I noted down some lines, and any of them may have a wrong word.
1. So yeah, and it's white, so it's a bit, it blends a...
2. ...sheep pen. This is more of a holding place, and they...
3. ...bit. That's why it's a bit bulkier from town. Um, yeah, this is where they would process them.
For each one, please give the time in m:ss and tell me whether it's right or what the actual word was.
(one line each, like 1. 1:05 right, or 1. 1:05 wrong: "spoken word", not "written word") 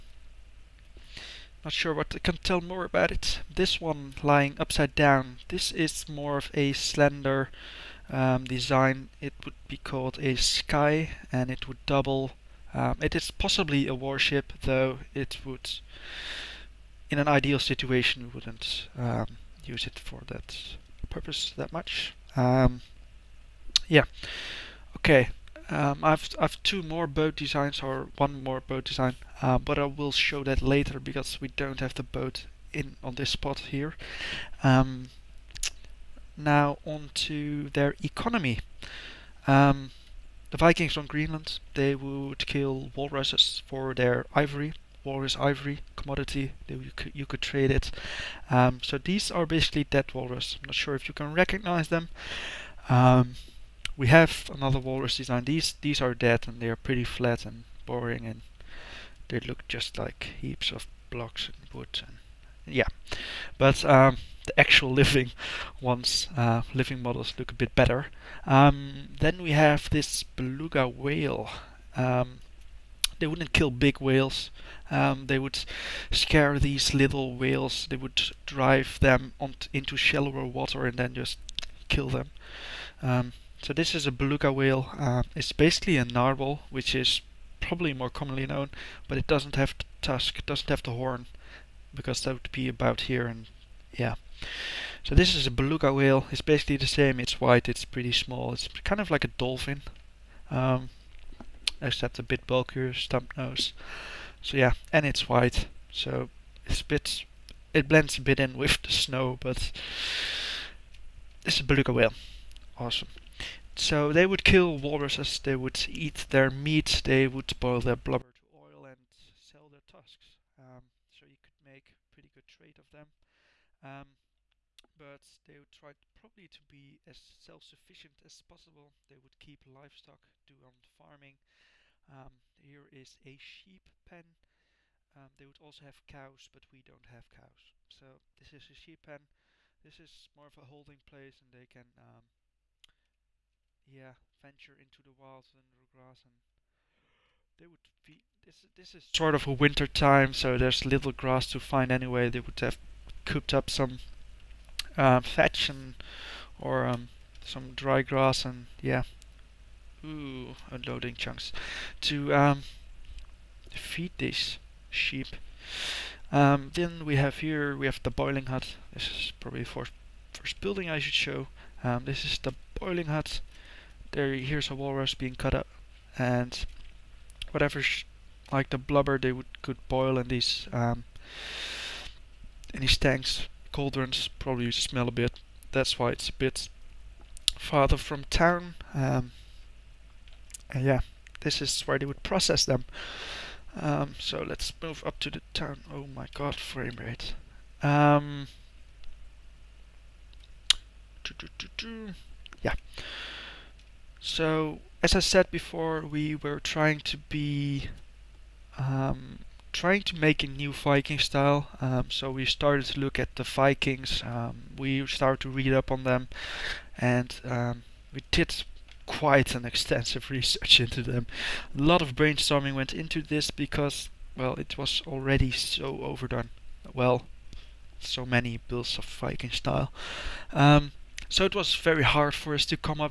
1. 1:44 right
2. 2:18 right
3. 3:05 wrong: "farther", not "bulkier".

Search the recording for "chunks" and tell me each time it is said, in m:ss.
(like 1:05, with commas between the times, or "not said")
2:41.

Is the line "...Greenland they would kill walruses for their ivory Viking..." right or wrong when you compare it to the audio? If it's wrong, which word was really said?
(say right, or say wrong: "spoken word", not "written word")
wrong: "Walrus", not "Viking".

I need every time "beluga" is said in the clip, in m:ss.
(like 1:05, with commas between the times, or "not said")
1:10, 1:24, 1:35, 1:51.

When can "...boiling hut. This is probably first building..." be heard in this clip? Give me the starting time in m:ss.
2:48.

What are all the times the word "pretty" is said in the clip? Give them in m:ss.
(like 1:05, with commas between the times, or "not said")
0:56, 1:37, 2:02.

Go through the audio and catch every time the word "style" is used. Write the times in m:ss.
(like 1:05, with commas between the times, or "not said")
3:31, 3:49.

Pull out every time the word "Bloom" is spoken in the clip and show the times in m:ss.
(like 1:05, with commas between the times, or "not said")
not said.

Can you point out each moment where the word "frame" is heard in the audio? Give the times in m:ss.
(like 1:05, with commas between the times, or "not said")
3:16.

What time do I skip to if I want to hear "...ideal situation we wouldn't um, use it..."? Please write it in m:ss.
0:17.